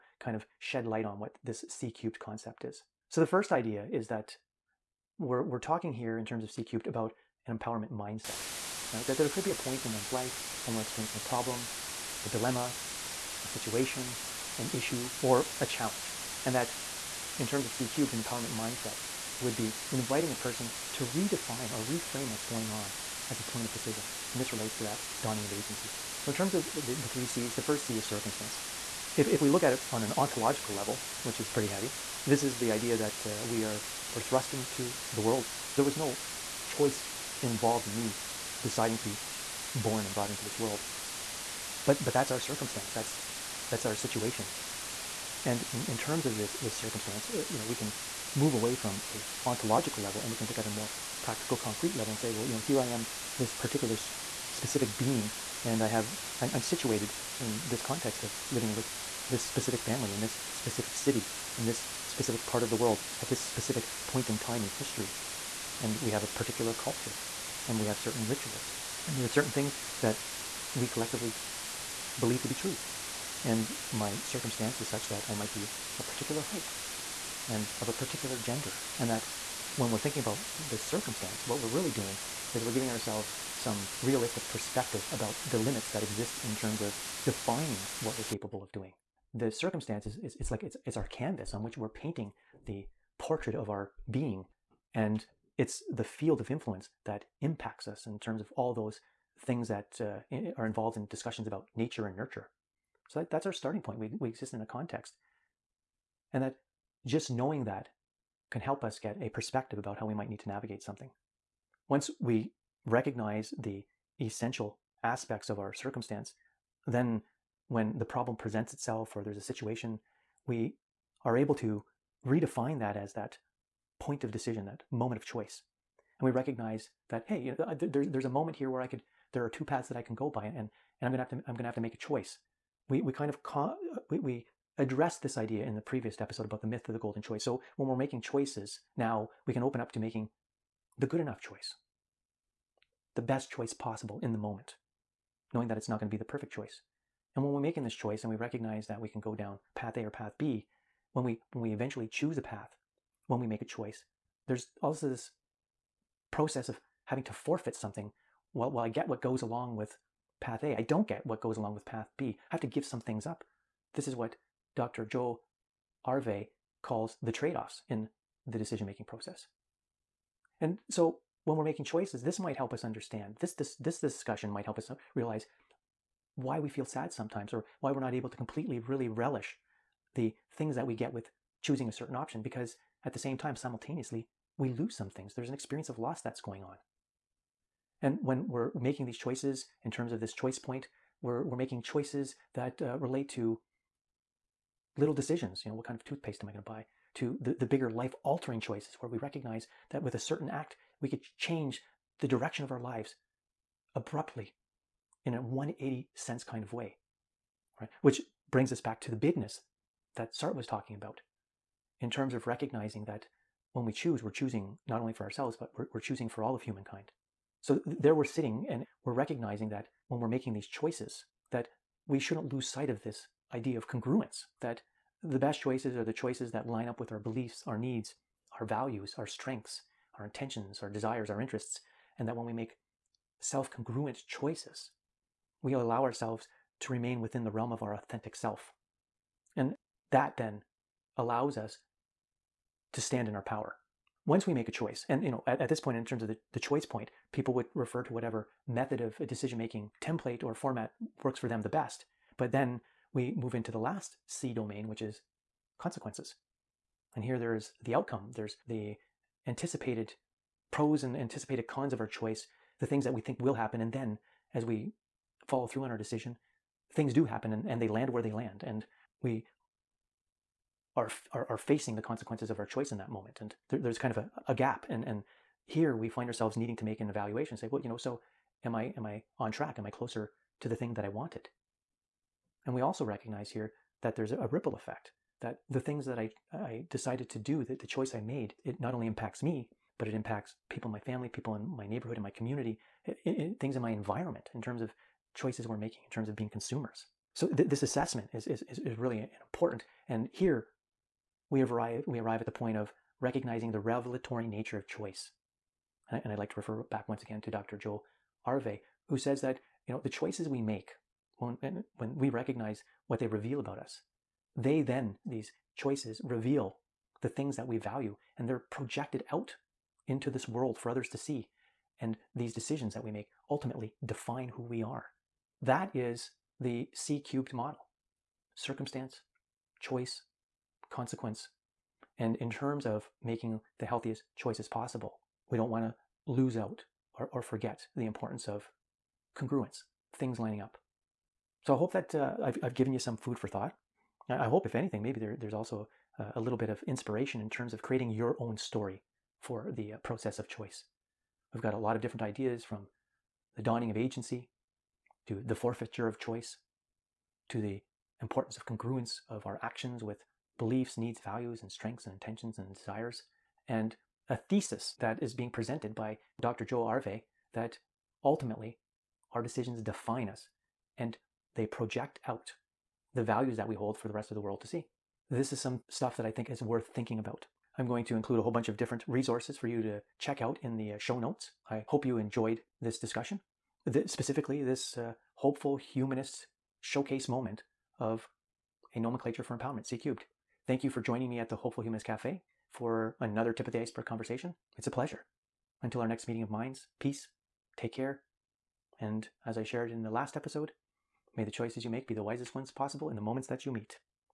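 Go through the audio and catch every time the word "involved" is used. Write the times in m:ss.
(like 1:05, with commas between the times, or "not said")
0:37, 1:40.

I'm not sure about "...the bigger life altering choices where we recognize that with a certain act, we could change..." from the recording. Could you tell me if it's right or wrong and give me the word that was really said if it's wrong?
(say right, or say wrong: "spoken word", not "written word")
right.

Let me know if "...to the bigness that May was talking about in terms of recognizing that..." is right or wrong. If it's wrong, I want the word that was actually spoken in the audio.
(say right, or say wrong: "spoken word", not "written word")
wrong: "Sartre", not "May".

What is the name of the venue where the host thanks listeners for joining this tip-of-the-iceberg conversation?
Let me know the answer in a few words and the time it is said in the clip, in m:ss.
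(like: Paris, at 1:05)
Hopeful Humanist Cafe, at 6:31.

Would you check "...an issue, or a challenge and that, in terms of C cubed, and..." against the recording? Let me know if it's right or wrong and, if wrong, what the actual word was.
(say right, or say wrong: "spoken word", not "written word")
right.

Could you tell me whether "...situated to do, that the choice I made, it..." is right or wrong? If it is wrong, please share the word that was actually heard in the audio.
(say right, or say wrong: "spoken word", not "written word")
wrong: "decided", not "situated".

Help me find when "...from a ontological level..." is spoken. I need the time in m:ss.
0:48.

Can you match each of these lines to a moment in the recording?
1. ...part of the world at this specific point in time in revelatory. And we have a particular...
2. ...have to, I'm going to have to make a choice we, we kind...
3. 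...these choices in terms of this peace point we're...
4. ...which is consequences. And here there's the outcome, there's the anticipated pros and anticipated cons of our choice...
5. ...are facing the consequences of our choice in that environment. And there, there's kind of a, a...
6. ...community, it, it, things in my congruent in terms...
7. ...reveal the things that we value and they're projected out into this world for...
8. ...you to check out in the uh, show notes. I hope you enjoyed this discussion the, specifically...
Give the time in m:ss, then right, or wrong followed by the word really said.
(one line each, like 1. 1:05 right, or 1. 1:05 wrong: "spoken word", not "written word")
1. 1:02 wrong: "history", not "revelatory"
2. 2:11 right
3. 3:09 wrong: "choice", not "peace"
4. 4:14 right
5. 4:31 wrong: "moment", not "environment"
6. 4:52 wrong: "environment", not "congruent"
7. 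5:16 right
8. 6:19 right.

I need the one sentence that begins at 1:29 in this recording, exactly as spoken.
The circumstance is, is it's like it's it's our canvas on which we're painting the portrait of our being.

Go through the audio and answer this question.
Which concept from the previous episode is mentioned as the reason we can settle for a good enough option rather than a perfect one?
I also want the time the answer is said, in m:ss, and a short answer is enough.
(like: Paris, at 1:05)
The myth of the golden choice, at 2:16.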